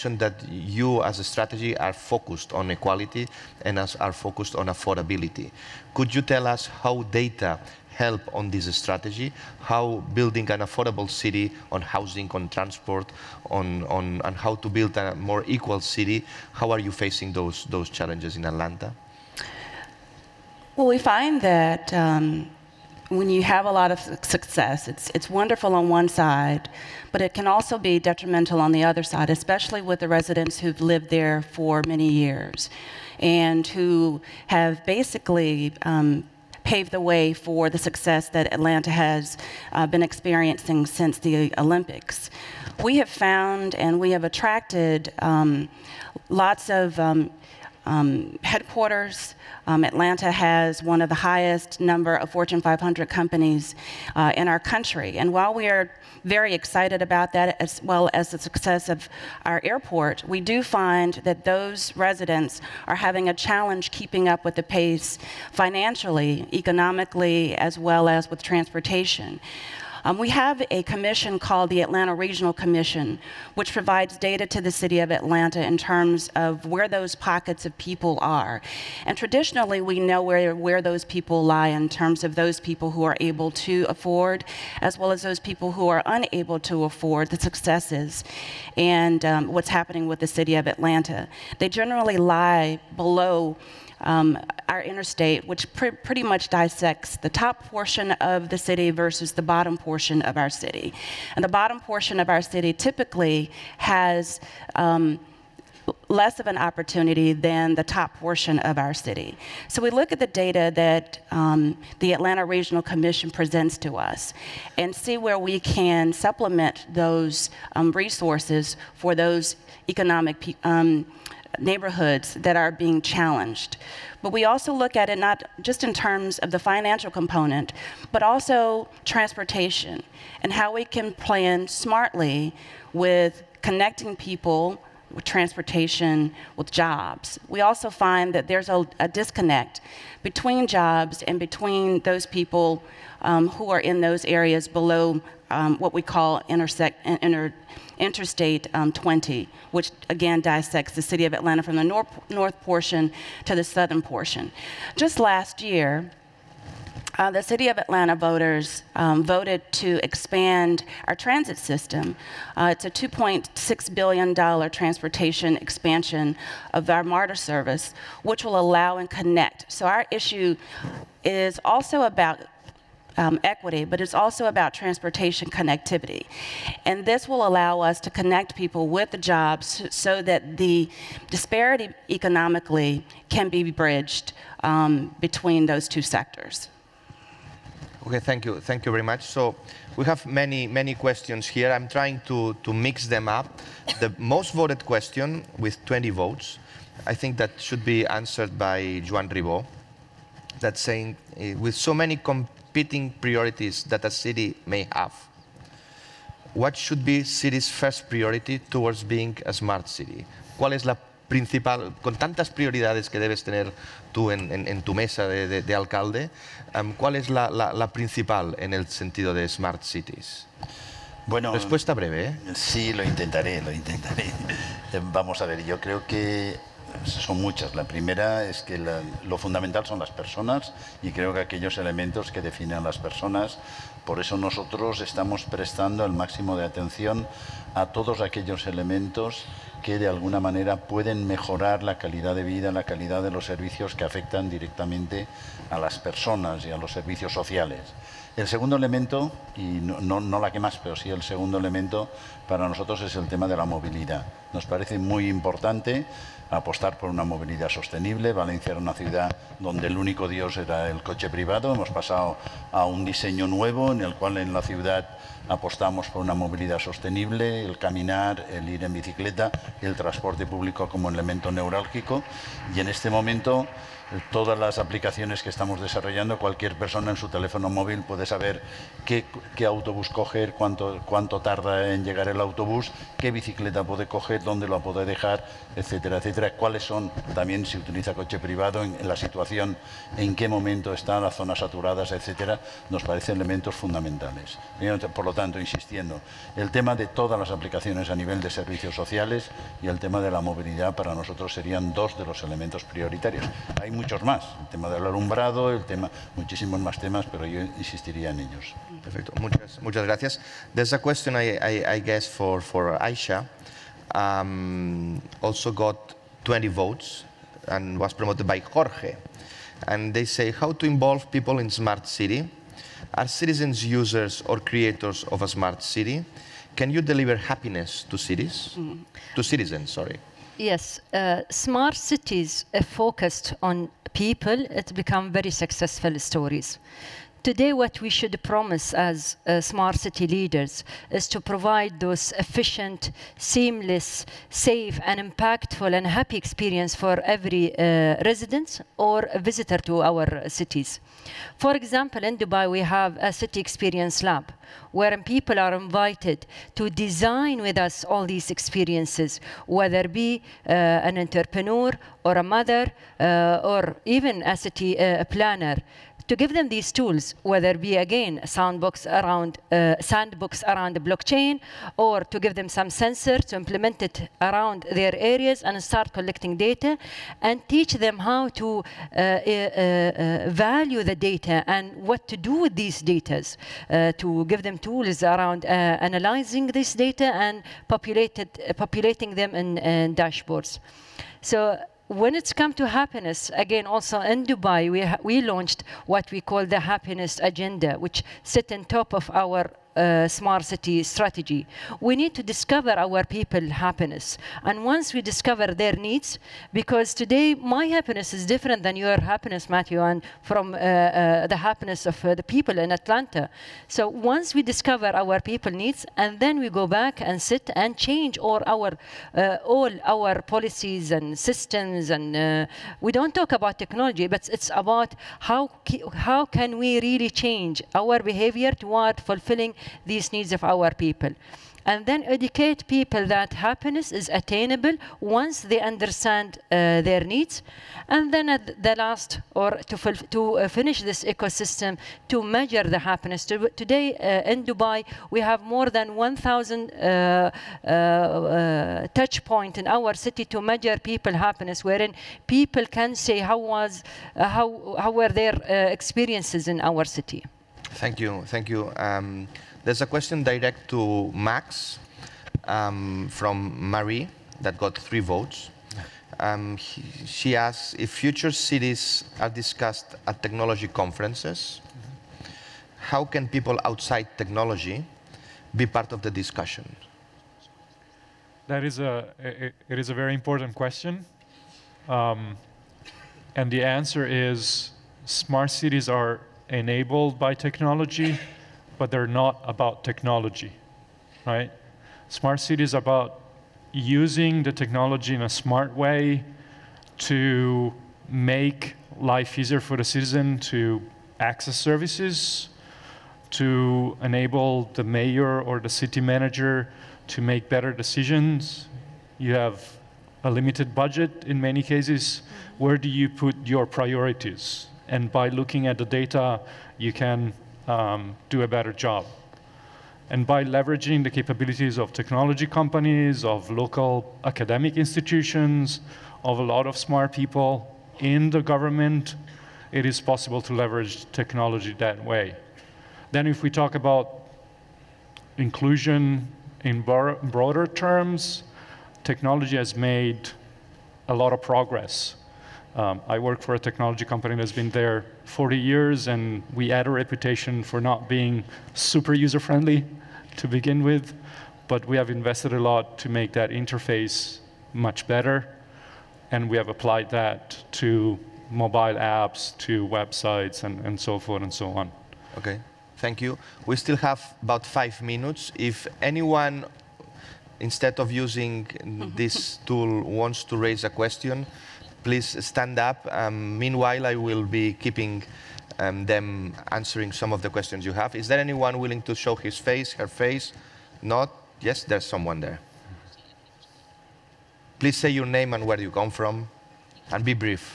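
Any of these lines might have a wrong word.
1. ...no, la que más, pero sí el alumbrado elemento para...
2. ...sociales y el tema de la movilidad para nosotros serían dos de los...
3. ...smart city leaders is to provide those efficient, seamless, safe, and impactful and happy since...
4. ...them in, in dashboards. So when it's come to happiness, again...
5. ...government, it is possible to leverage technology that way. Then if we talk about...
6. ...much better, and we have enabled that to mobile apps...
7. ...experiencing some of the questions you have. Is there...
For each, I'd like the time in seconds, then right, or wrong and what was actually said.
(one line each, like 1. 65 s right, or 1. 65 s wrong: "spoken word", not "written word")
1. 250 s wrong: "segundo", not "alumbrado"
2. 298 s right
3. 339 s wrong: "experience", not "since"
4. 389 s right
5. 528 s right
6. 554 s wrong: "applied", not "enabled"
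7. 576 s wrong: "answering", not "experiencing".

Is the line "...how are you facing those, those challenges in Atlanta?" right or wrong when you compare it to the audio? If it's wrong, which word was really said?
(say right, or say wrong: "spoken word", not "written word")
right.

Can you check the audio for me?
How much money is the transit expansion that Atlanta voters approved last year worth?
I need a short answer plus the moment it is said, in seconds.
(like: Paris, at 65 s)
$2.6 billion, at 162 s.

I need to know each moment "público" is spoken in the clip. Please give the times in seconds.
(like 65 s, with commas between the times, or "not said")
270 s.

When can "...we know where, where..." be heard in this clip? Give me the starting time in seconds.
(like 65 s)
79 s.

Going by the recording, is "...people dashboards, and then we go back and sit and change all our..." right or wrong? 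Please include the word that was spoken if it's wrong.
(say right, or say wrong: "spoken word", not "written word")
wrong: "needs", not "dashboards".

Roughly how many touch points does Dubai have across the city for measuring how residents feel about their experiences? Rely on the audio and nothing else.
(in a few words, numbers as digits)
1000.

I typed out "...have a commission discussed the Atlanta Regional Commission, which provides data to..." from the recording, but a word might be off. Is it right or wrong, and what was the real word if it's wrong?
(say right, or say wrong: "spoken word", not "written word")
wrong: "called", not "discussed".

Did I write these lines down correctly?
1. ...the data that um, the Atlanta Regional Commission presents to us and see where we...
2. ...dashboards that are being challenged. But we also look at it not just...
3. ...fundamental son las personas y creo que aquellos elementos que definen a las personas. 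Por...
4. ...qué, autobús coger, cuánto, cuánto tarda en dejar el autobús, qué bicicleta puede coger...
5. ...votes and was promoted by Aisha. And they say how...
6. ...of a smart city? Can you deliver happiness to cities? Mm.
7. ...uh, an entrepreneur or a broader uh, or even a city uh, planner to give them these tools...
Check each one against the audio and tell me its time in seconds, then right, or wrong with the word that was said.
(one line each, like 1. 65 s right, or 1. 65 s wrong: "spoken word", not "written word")
1. 110 s right
2. 121 s wrong: "neighborhoods", not "dashboards"
3. 229 s right
4. 279 s wrong: "llegar", not "dejar"
5. 316 s wrong: "Jorge", not "Aisha"
6. 325 s right
7. 360 s wrong: "mother", not "broader".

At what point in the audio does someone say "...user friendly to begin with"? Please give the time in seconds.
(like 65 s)
549 s.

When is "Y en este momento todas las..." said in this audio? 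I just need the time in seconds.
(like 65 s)
272 s.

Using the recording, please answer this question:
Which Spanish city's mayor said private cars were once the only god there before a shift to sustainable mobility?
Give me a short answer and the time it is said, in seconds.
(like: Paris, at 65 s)
Valencia, at 258 s.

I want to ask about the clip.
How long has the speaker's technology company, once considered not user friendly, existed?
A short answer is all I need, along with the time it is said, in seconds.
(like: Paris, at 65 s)
40 years, at 545 s.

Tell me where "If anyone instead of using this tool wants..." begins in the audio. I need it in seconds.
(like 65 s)
565 s.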